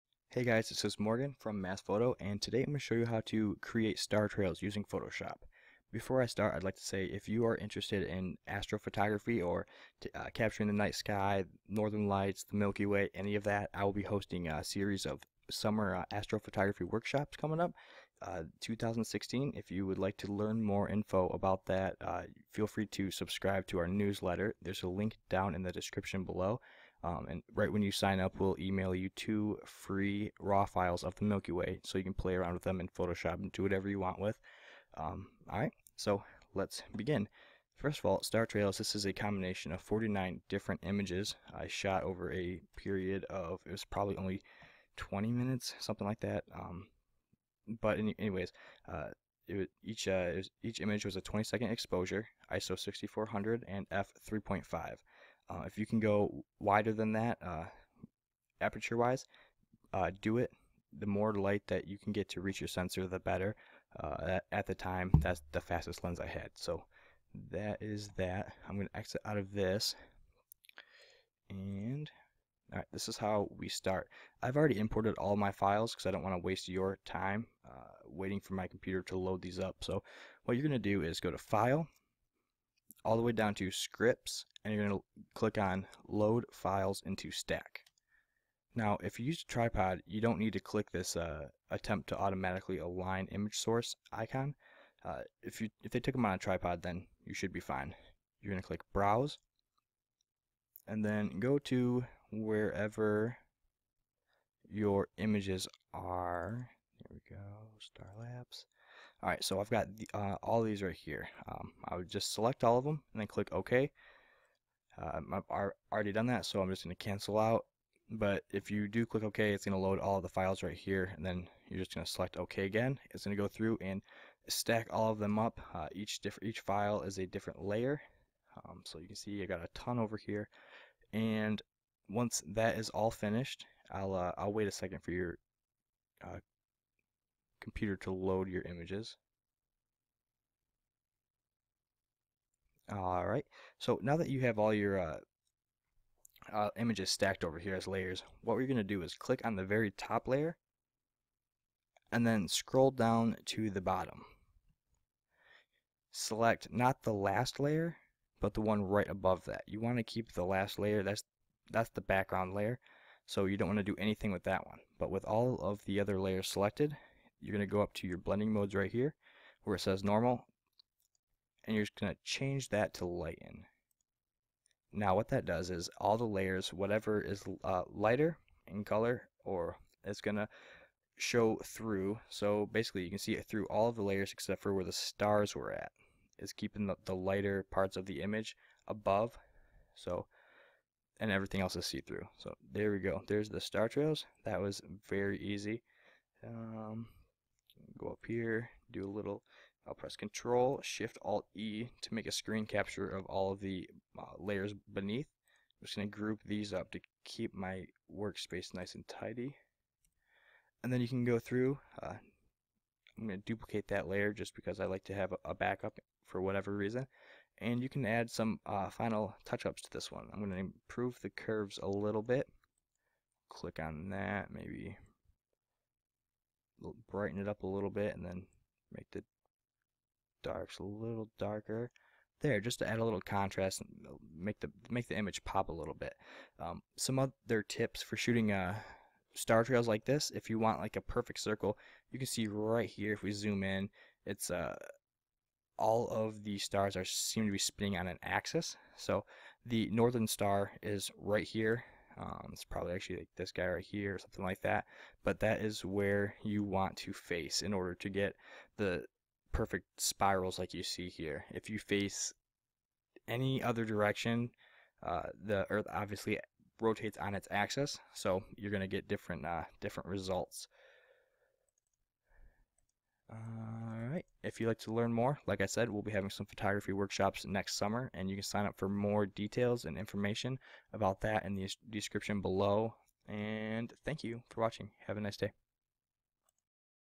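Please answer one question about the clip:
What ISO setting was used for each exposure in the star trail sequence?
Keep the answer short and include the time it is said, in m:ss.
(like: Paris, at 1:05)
6400, at 0:52.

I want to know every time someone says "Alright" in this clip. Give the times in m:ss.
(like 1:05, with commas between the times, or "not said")
0:35, 1:49, 4:33.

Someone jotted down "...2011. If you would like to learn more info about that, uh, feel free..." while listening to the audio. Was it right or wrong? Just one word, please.
wrong.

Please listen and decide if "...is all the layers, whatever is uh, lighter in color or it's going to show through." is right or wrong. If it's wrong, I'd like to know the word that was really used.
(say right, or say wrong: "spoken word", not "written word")
right.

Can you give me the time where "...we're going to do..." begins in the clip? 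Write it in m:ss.
2:28.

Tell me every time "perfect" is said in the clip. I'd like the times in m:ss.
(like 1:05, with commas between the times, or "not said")
4:01, 4:19.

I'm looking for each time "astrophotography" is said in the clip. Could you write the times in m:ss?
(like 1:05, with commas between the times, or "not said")
0:08, 0:16.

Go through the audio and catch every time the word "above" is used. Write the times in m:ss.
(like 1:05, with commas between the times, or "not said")
2:39, 3:08.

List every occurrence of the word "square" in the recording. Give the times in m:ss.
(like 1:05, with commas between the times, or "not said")
not said.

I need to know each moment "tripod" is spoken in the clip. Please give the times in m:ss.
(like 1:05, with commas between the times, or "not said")
1:29, 1:36.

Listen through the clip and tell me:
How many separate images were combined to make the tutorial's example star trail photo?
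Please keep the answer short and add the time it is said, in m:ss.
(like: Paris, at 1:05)
49, at 0:39.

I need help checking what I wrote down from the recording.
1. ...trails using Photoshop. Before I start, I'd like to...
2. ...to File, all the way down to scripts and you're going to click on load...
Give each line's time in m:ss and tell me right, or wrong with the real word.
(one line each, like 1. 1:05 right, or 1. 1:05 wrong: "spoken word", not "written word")
1. 0:04 right
2. 1:21 right.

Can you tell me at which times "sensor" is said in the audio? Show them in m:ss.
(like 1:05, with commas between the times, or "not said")
1:02.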